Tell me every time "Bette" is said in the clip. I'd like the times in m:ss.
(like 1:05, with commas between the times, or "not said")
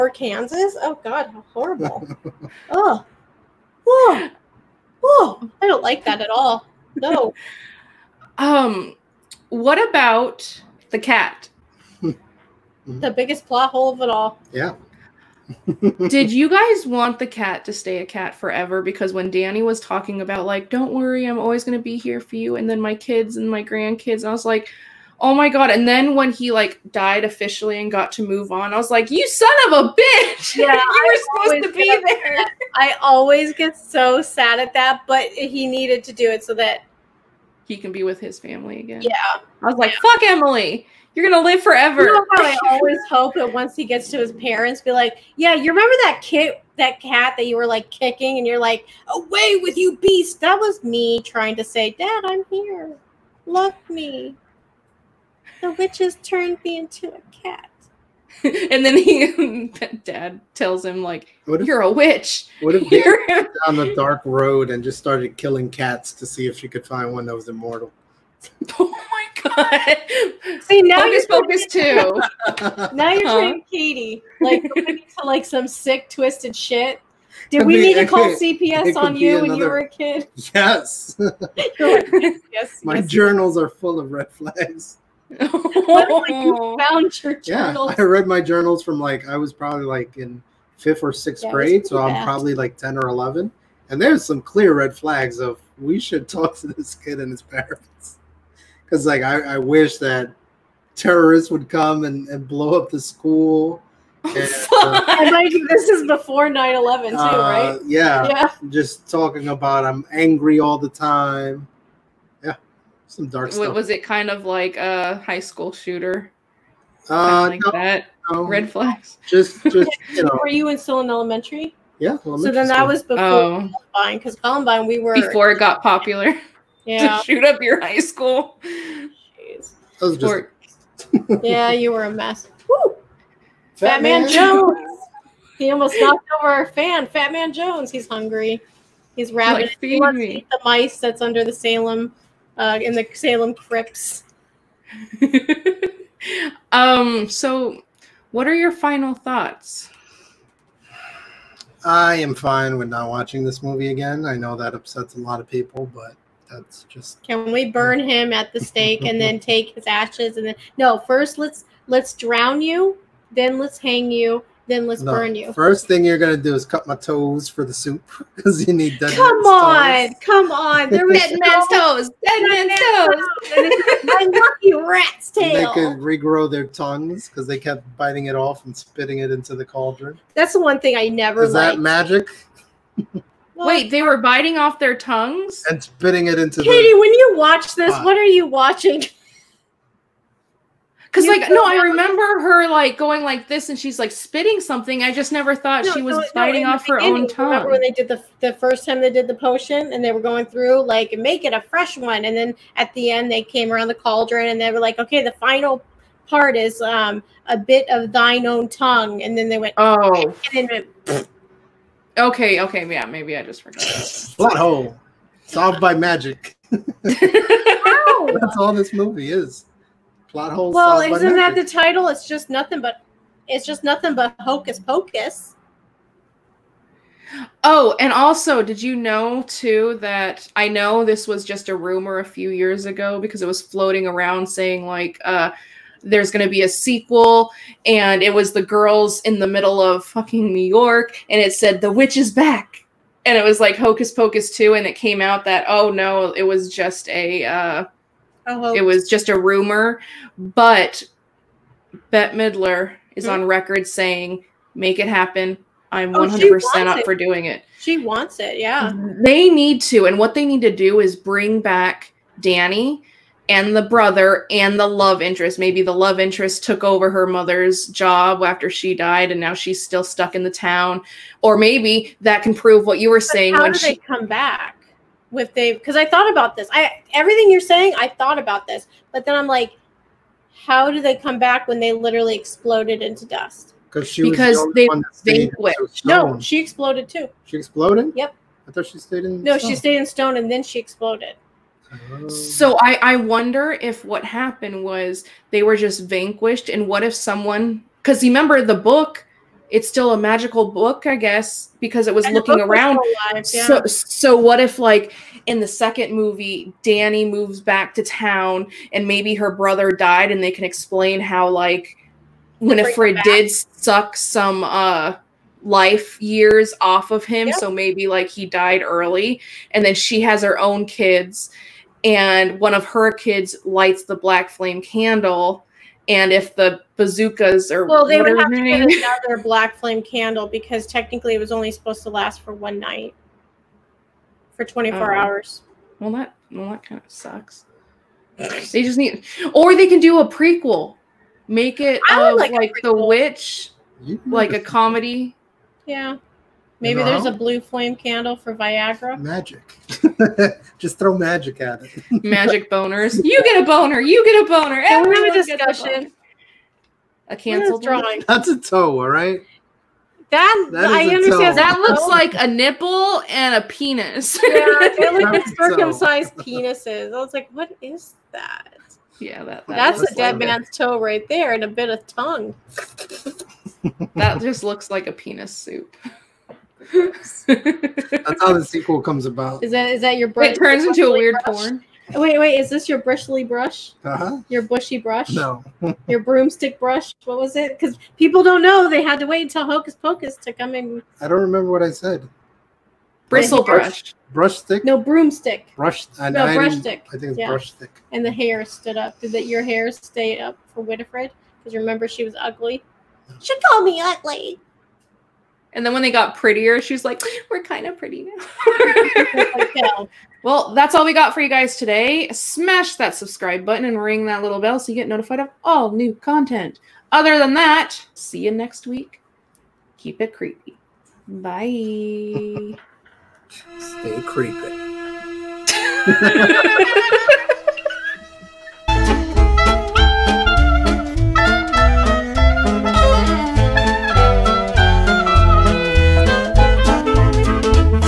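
4:12.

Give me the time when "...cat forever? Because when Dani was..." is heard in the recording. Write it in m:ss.
0:18.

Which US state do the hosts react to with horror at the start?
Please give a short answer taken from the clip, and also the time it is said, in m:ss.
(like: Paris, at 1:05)
Kansas, at 0:00.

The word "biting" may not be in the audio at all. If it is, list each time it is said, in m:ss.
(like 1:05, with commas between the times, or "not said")
2:57, 3:04, 3:16.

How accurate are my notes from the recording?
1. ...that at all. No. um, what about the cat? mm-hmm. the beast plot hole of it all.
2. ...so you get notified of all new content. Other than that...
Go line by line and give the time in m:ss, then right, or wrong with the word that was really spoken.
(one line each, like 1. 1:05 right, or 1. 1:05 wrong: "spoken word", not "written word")
1. 0:06 wrong: "biggest", not "beast"
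2. 6:54 right.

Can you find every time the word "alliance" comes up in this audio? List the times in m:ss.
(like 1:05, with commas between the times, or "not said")
not said.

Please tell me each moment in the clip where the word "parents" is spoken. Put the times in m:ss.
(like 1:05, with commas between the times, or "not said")
0:44, 1:37.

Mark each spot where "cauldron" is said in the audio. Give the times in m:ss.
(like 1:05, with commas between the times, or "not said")
2:59, 3:23.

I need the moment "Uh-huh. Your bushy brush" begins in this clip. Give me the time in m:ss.
6:24.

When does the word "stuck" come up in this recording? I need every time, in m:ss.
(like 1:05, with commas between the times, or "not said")
4:30.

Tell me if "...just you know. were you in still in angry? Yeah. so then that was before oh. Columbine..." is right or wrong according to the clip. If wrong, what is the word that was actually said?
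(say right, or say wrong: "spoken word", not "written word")
wrong: "elementary", not "angry".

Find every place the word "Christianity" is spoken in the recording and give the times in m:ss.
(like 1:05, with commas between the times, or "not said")
not said.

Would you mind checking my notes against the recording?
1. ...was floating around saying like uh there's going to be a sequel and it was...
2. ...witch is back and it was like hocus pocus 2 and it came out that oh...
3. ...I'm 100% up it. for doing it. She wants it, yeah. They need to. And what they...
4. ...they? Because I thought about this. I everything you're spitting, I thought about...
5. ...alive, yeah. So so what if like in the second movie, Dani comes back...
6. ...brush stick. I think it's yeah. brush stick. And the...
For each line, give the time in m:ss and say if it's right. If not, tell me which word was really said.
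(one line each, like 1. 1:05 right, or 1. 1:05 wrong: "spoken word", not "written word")
1. 3:53 right
2. 4:01 right
3. 4:15 right
4. 4:35 wrong: "saying", not "spitting"
5. 5:03 wrong: "moves", not "comes"
6. 6:36 right.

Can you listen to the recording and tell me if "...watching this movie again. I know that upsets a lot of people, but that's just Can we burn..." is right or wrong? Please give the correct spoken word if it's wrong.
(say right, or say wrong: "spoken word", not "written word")
right.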